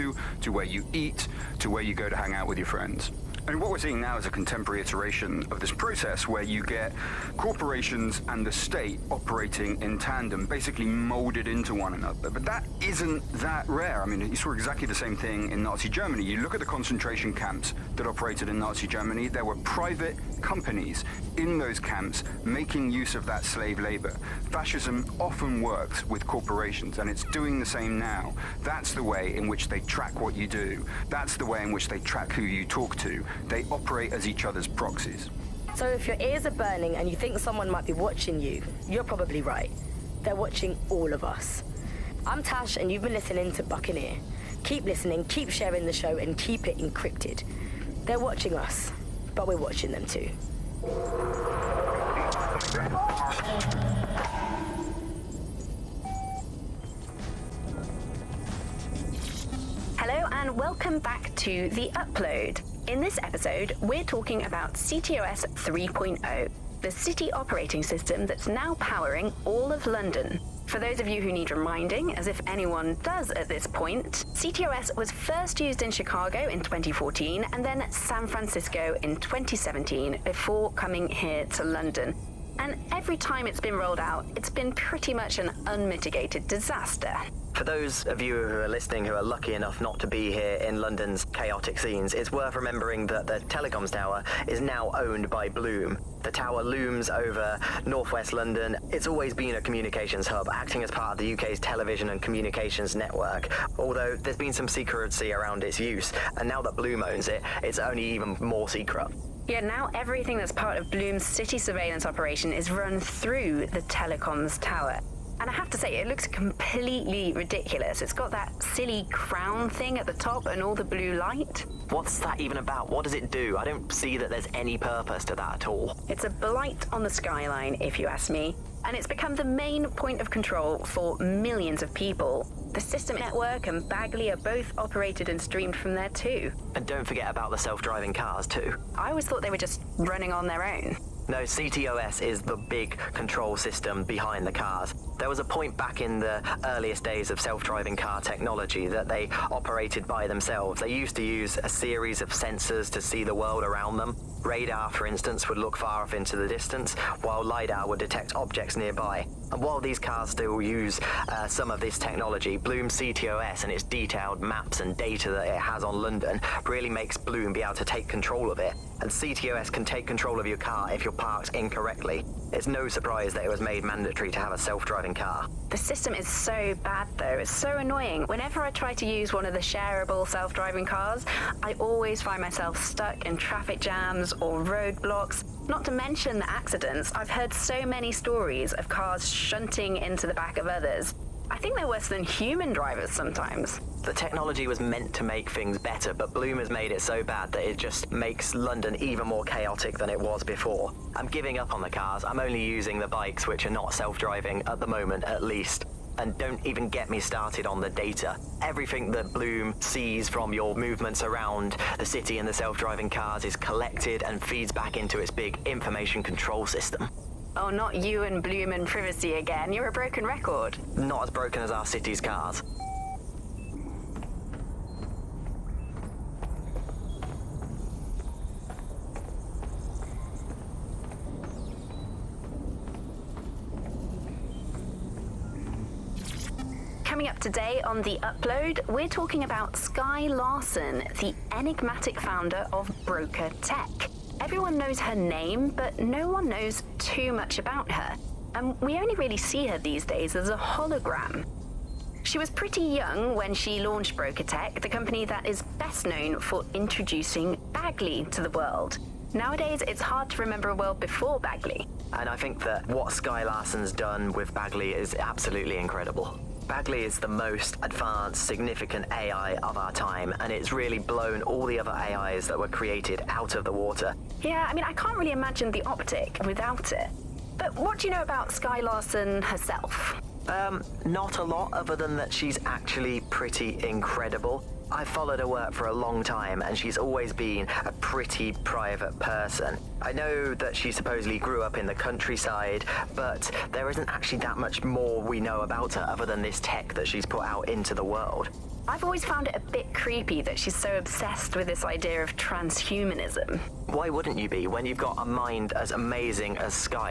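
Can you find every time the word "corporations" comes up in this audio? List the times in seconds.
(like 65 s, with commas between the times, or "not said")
7 s, 26 s.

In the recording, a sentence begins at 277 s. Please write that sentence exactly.
But what do you know about Skye Larsen herself?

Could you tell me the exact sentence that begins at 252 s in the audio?
She was pretty young when she launched Broca Tech, the company that is best known for introducing Bagley to the world.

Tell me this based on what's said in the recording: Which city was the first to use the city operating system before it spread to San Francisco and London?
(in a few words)
Chicago.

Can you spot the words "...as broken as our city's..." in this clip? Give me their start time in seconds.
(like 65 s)
221 s.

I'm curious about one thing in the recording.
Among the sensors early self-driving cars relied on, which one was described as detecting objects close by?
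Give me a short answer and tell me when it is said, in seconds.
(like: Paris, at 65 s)
LiDAR, at 157 s.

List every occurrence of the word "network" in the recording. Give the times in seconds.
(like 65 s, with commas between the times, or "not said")
102 s, 133 s.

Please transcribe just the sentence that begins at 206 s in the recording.
And don't even get me started on the data.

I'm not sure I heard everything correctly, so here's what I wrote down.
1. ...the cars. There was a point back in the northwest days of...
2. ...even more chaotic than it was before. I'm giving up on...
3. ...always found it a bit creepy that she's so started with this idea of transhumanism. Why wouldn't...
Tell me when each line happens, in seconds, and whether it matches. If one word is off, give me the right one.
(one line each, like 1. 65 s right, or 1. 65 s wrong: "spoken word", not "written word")
1. 144 s wrong: "earliest", not "northwest"
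2. 198 s right
3. 299 s wrong: "obsessed", not "started".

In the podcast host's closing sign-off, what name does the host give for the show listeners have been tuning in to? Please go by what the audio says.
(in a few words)
Buccaneer.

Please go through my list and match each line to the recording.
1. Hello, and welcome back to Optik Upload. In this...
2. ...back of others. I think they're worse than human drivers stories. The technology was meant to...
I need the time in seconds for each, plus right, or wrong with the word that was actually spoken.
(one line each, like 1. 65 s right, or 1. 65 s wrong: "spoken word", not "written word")
1. 59 s wrong: "The", not "Optik"
2. 190 s wrong: "sometimes", not "stories".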